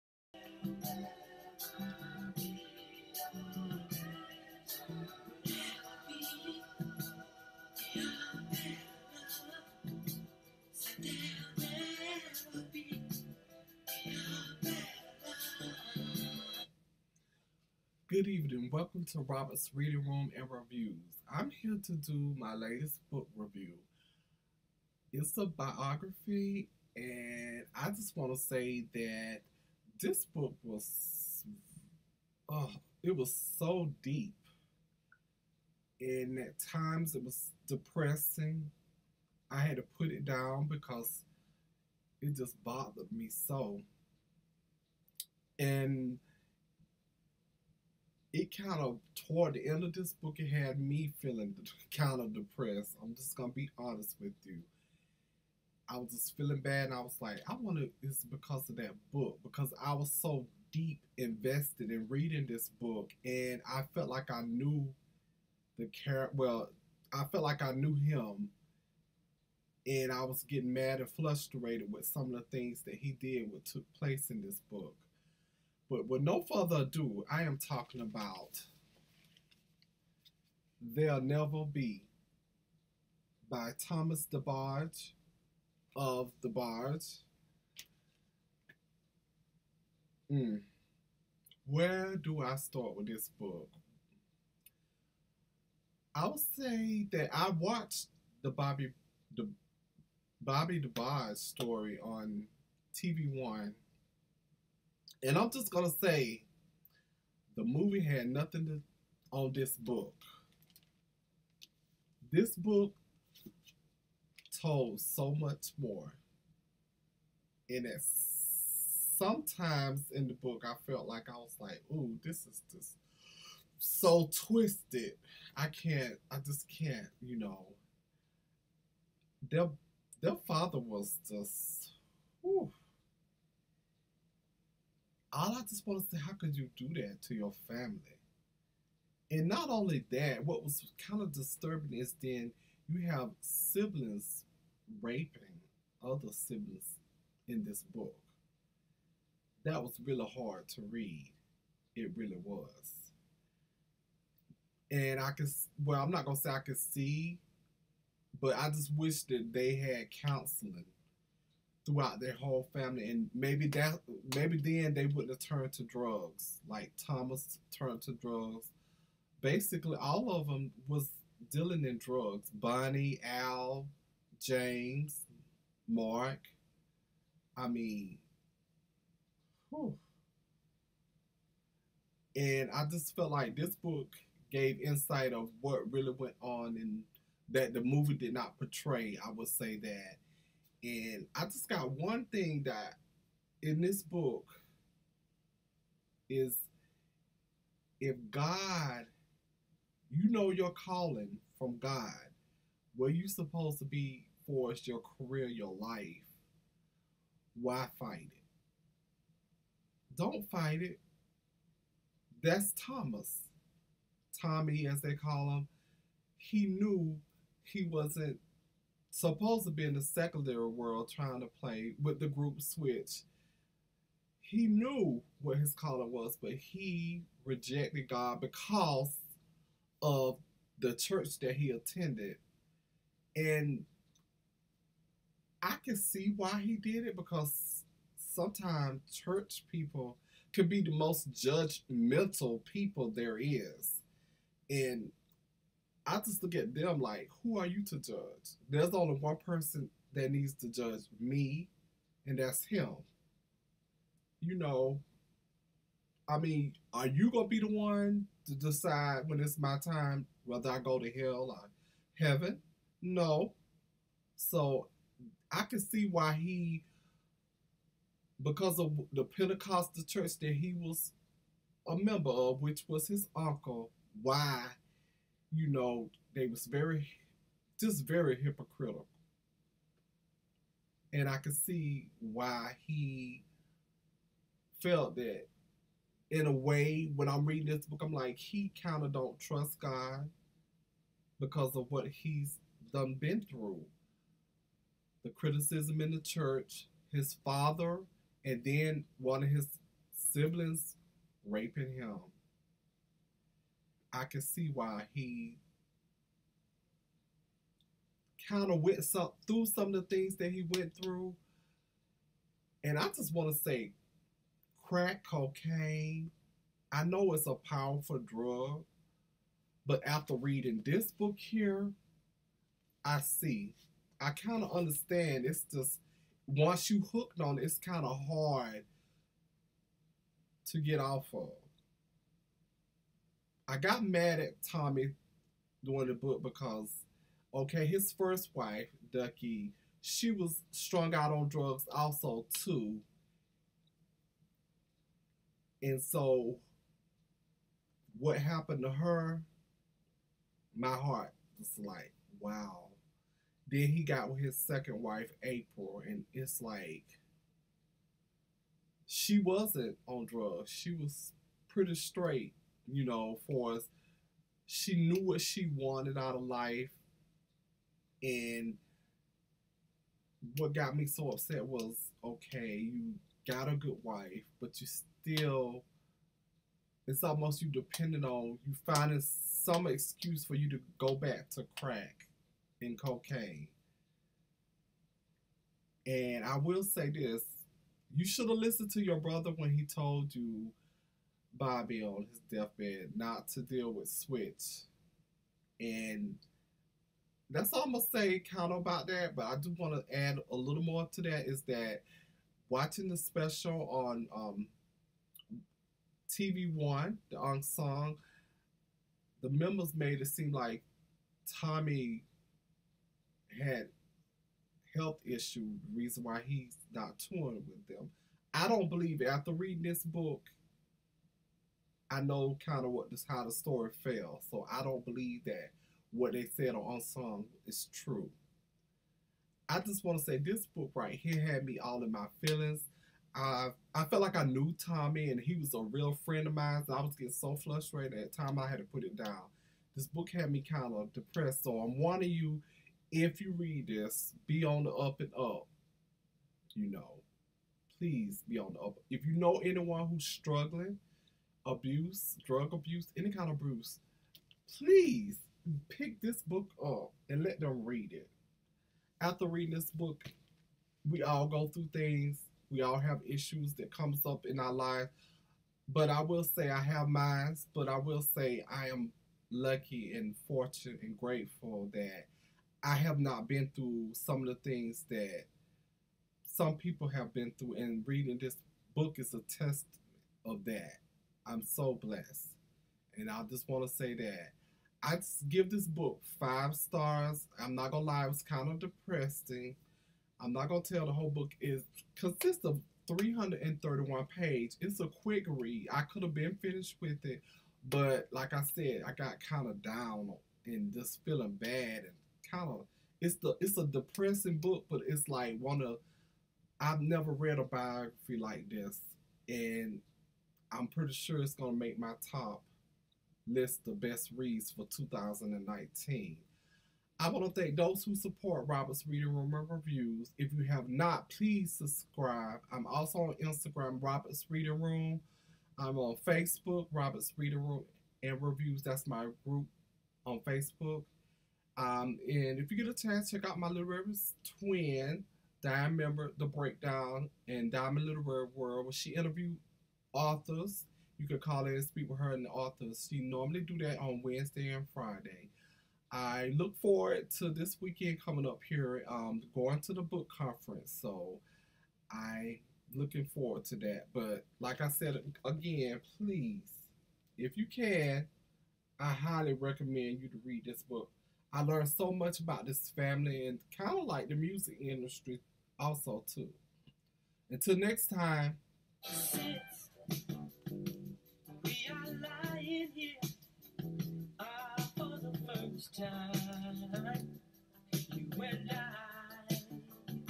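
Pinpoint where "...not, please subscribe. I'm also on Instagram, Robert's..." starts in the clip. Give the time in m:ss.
8:40.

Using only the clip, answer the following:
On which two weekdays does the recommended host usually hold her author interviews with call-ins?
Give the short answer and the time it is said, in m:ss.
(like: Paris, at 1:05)
Wednesday and Friday, at 9:04.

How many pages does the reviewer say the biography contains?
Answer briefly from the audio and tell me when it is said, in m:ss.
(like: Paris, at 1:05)
331, at 8:13.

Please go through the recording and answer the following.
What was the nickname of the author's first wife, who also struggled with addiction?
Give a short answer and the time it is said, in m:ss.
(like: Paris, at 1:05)
Ducky, at 5:39.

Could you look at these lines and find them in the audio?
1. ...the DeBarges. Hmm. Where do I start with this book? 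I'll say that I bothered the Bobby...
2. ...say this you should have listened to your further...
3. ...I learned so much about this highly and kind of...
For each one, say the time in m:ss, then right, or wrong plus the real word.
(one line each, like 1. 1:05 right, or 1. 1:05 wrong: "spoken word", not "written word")
1. 1:26 wrong: "watched", not "bothered"
2. 6:26 wrong: "brother", not "further"
3. 9:21 wrong: "family", not "highly".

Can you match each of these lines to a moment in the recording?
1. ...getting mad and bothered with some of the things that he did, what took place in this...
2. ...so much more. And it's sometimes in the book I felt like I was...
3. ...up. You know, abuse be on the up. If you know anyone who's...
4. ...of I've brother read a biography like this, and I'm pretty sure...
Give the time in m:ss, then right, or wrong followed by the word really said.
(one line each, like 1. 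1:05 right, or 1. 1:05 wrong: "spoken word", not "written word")
1. 1:10 wrong: "frustrated", not "bothered"
2. 1:54 right
3. 7:25 wrong: "please", not "abuse"
4. 8:25 wrong: "never", not "brother".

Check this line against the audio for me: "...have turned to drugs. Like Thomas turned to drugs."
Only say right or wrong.
right.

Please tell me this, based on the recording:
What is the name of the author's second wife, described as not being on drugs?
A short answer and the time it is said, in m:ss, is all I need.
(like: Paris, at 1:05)
April, at 5:55.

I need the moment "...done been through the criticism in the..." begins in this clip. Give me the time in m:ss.
4:52.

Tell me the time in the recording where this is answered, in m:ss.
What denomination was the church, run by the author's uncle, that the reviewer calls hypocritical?
4:29.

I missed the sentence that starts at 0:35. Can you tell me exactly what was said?
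And at times it was depressing.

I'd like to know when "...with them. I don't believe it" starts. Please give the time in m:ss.
6:57.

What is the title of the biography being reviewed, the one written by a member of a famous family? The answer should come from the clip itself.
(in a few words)
There'll Never Be.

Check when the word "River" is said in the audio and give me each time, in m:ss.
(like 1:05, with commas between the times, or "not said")
8:53, 8:58.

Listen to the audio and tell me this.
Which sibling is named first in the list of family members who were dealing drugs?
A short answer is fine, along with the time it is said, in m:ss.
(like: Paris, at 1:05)
Bunny, at 2:52.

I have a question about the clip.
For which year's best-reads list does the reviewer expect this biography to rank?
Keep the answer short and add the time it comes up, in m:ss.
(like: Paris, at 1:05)
2019, at 8:34.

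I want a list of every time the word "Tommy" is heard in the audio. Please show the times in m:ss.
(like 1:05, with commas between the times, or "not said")
3:34, 5:34, 6:51, 7:14.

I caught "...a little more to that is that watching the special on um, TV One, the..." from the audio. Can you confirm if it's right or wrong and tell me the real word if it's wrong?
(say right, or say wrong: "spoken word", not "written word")
right.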